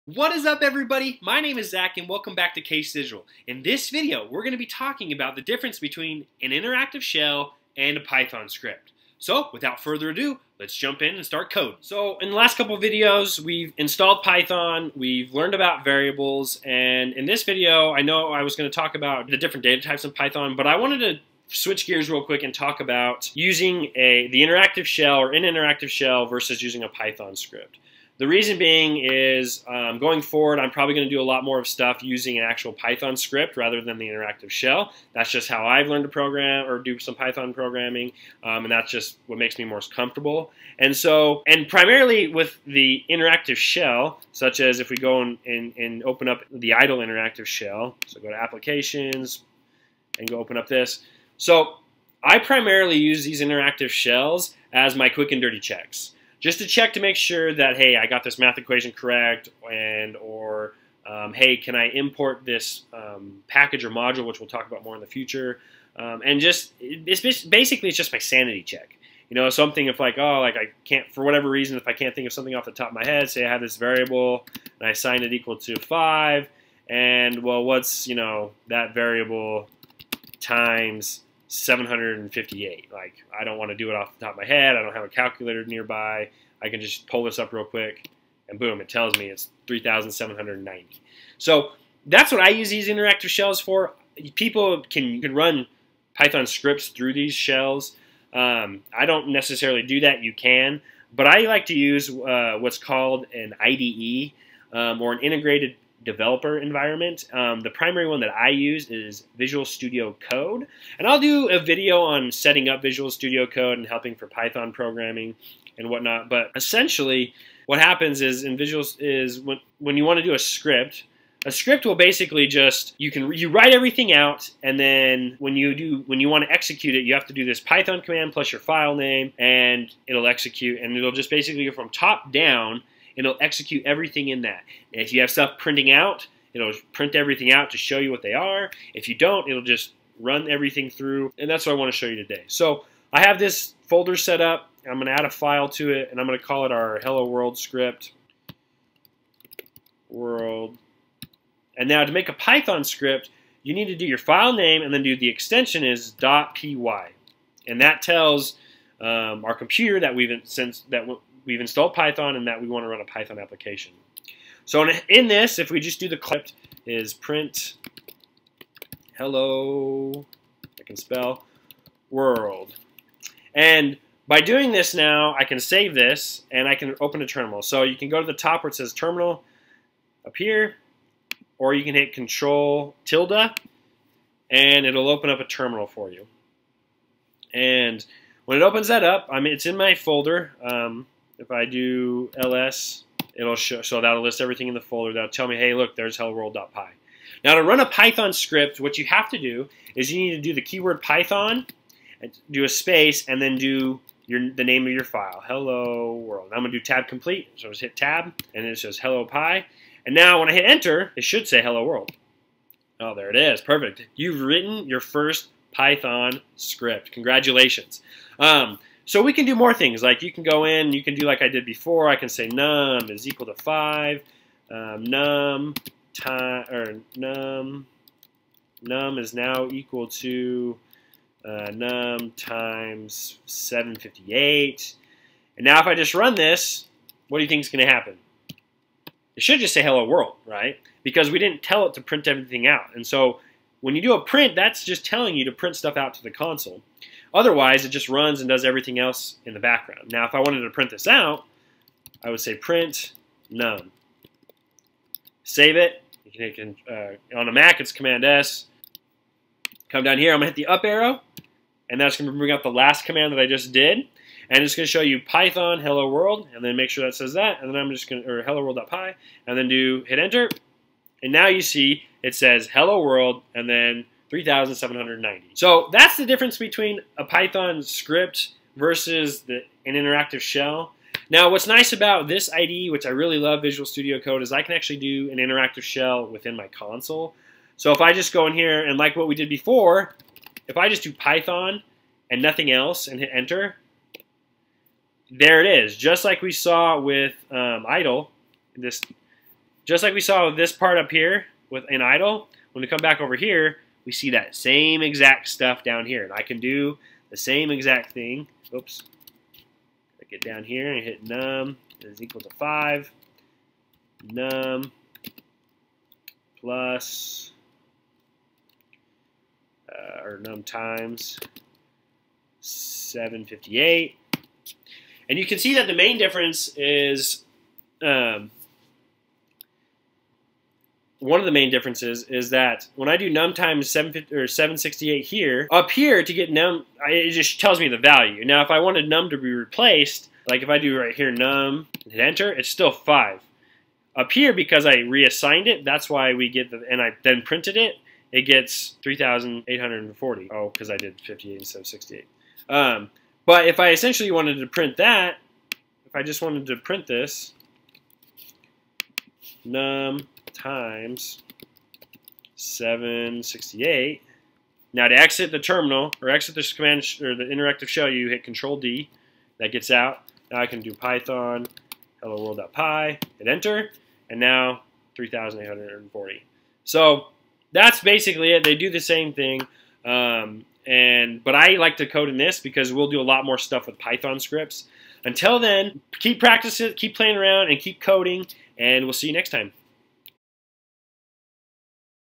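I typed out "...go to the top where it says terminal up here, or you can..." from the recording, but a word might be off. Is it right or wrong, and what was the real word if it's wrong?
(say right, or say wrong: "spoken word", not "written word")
right.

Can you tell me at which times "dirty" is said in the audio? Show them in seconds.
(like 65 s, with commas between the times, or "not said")
55 s.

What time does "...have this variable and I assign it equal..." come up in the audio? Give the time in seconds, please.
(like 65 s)
73 s.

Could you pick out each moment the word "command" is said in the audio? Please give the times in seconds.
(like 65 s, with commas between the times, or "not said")
128 s, 257 s, 263 s, 366 s.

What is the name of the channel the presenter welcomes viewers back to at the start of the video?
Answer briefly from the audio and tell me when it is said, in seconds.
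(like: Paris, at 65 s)
Case Digital, at 2 s.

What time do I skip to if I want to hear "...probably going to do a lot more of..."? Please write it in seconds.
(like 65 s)
30 s.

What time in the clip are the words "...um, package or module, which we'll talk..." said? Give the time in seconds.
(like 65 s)
62 s.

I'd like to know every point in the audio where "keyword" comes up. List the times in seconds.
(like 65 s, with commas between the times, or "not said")
200 s.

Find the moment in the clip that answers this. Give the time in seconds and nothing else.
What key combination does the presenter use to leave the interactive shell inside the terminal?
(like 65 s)
368 s.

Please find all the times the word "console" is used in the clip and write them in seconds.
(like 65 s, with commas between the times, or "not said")
246 s, 286 s.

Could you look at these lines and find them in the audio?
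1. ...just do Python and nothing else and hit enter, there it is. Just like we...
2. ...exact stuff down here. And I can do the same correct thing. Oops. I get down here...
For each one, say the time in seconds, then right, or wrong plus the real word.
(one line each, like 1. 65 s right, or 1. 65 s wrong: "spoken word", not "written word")
1. 290 s right
2. 305 s wrong: "exact", not "correct".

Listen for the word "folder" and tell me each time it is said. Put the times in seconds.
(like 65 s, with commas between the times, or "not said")
143 s, 189 s, 194 s.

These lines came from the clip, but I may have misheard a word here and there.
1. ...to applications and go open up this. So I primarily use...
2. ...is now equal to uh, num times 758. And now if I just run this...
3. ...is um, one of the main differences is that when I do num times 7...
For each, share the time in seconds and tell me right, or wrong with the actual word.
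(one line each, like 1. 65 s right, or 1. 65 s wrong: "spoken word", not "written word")
1. 48 s right
2. 229 s right
3. 326 s right.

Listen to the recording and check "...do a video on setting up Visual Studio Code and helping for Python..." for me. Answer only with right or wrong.
right.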